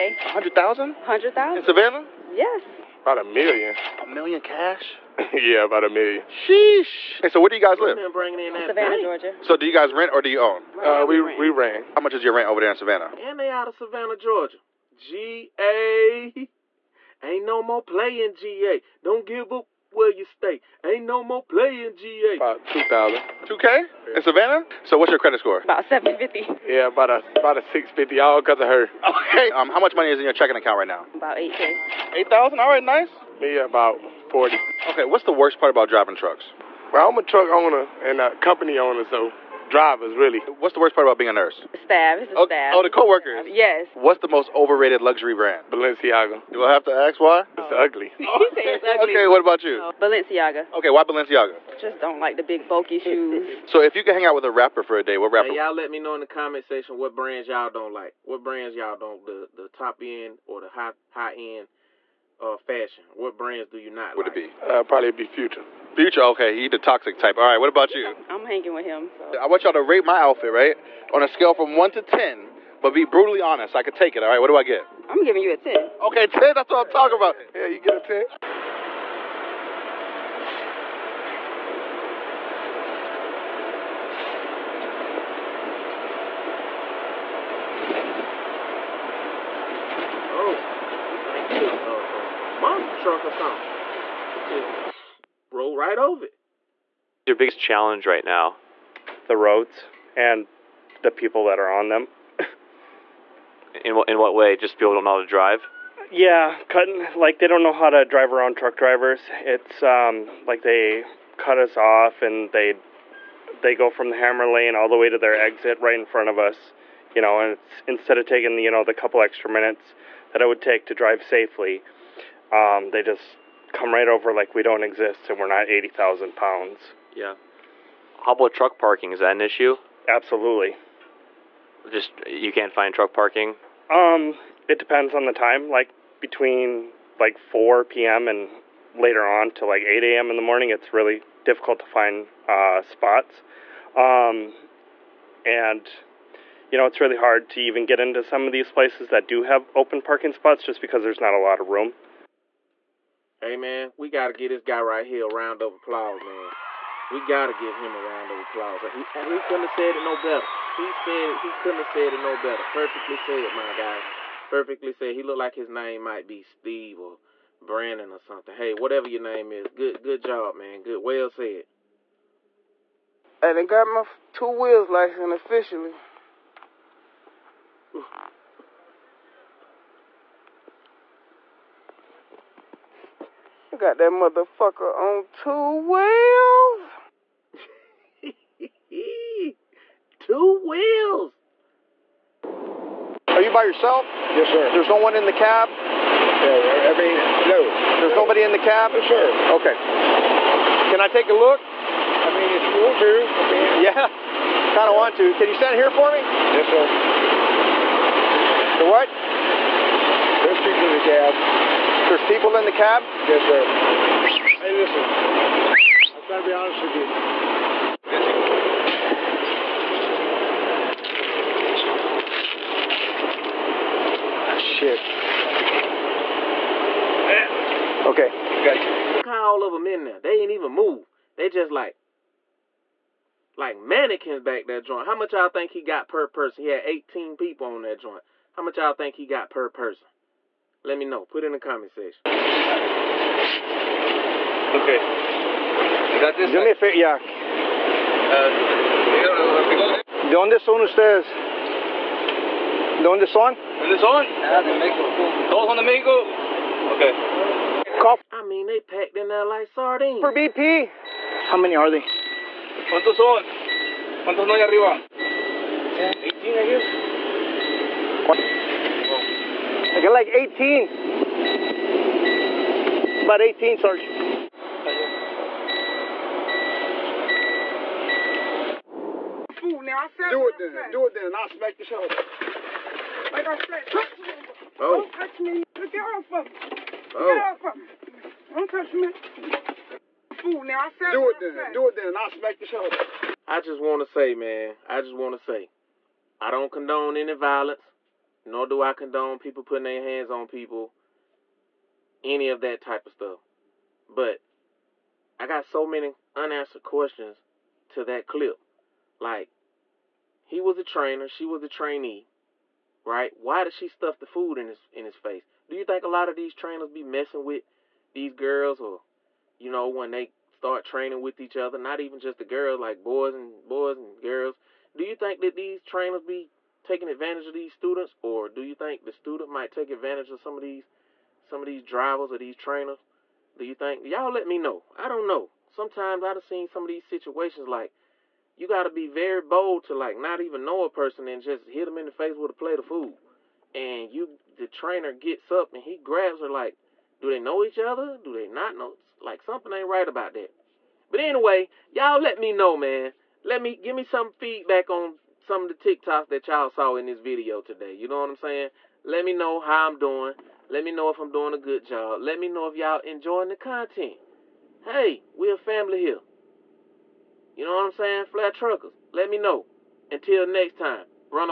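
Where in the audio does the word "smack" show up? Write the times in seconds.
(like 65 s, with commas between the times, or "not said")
281 s, 292 s.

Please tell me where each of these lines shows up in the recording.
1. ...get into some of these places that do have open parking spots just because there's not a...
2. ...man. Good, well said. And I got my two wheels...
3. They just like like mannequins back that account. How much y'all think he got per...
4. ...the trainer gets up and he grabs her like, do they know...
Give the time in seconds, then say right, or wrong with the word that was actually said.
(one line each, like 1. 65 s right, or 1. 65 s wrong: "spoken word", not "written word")
1. 147 s right
2. 170 s right
3. 231 s wrong: "joint", not "account"
4. 344 s right.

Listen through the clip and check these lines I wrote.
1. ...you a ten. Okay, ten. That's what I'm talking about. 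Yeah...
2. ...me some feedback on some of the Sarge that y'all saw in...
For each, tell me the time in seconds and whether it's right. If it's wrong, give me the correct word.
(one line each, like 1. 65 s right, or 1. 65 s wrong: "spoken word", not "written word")
1. 75 s right
2. 353 s wrong: "TikToks", not "Sarge".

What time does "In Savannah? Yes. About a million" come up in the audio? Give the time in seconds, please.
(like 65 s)
1 s.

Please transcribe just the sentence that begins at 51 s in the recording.
Just don't like the big bulky shoes.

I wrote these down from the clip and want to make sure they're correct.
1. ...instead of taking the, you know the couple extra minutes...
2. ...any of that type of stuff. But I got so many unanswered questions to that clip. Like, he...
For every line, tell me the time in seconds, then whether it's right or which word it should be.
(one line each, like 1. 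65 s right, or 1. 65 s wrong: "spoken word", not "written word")
1. 117 s right
2. 302 s right.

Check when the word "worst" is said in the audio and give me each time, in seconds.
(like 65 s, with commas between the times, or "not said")
35 s, 40 s.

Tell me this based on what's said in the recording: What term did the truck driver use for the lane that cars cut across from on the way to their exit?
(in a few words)
hammer lane.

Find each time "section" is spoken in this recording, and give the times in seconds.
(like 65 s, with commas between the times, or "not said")
56 s, 241 s.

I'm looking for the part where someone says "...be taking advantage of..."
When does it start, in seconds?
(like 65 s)
326 s.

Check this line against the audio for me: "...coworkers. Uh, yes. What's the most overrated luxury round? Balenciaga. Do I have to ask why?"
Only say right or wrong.
wrong.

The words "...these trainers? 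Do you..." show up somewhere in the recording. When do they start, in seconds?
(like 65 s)
332 s.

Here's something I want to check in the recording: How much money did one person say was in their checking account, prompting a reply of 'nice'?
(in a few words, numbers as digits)
8,000.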